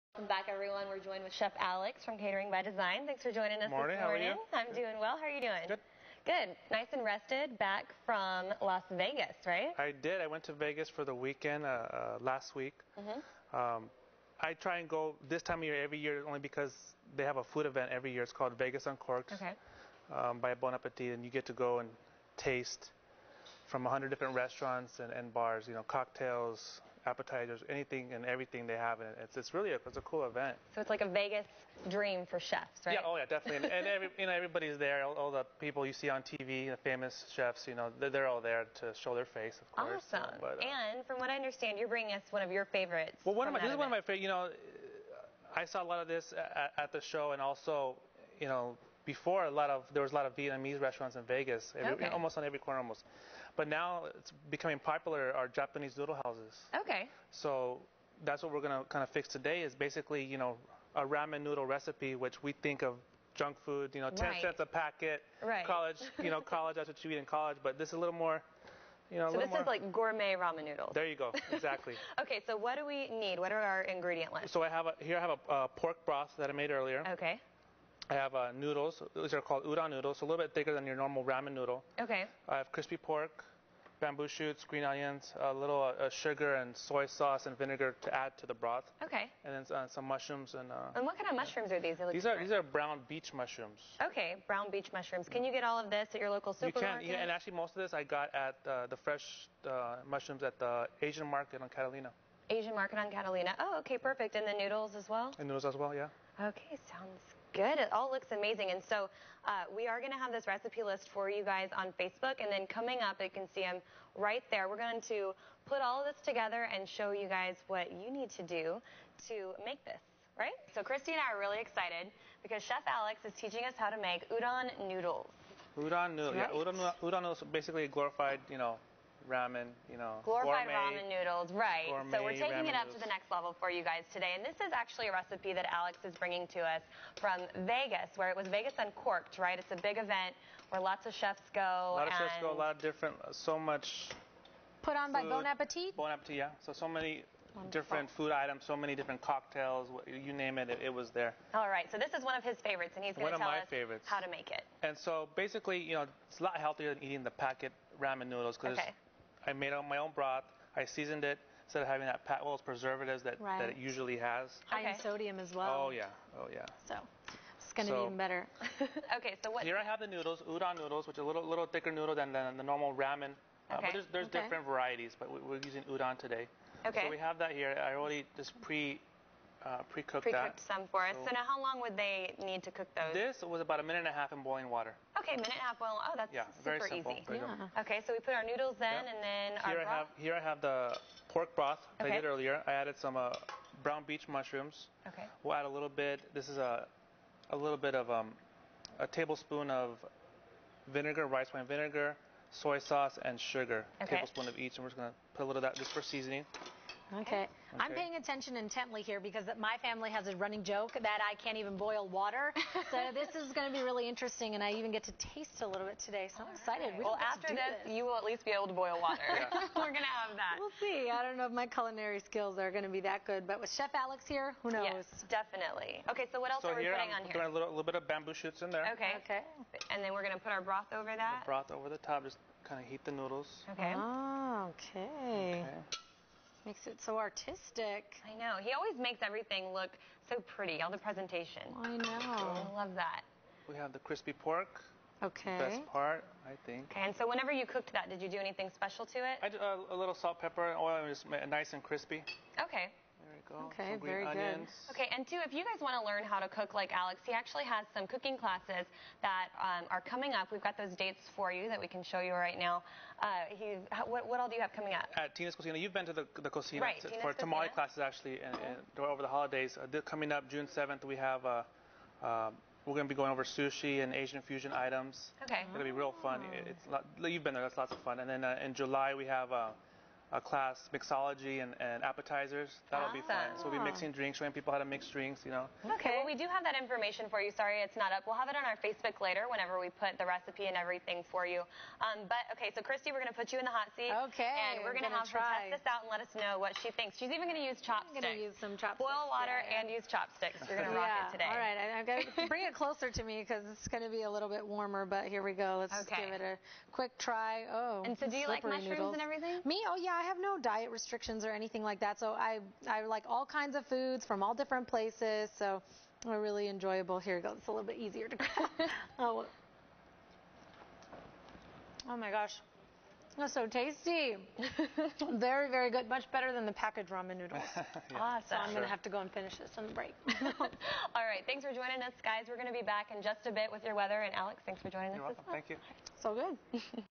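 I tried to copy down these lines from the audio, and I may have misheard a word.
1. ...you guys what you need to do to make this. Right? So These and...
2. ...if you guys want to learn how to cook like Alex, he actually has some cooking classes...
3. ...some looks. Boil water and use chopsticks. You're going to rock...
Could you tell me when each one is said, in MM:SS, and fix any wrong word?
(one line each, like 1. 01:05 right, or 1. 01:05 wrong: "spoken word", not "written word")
1. 01:57 wrong: "Christi", not "These"
2. 04:15 right
3. 04:58 wrong: "chopsticks", not "looks".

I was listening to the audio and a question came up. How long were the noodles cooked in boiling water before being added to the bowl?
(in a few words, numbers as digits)
a minute and a half.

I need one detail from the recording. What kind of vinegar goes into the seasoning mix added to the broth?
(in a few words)
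rice wine vinegar.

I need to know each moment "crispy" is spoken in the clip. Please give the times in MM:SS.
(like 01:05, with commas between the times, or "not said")
01:22, 04:03, 04:11.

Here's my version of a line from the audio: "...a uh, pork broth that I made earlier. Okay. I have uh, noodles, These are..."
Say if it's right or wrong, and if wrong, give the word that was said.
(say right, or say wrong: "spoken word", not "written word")
right.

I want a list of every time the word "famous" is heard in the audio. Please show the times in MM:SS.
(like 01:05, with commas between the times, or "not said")
00:36.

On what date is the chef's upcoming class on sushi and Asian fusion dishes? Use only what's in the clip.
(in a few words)
June 7.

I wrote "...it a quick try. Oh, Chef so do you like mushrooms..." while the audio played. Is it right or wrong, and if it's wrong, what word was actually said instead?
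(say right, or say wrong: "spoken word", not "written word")
wrong: "And", not "Chef".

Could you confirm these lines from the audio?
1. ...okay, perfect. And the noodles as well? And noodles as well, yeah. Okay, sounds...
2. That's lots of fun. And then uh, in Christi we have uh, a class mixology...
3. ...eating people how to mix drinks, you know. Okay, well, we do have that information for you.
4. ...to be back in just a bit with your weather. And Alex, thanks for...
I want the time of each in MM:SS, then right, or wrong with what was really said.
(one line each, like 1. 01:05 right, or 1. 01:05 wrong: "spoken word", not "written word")
1. 01:43 right
2. 04:37 wrong: "July", not "Christi"
3. 04:44 wrong: "showing", not "eating"
4. 05:32 right.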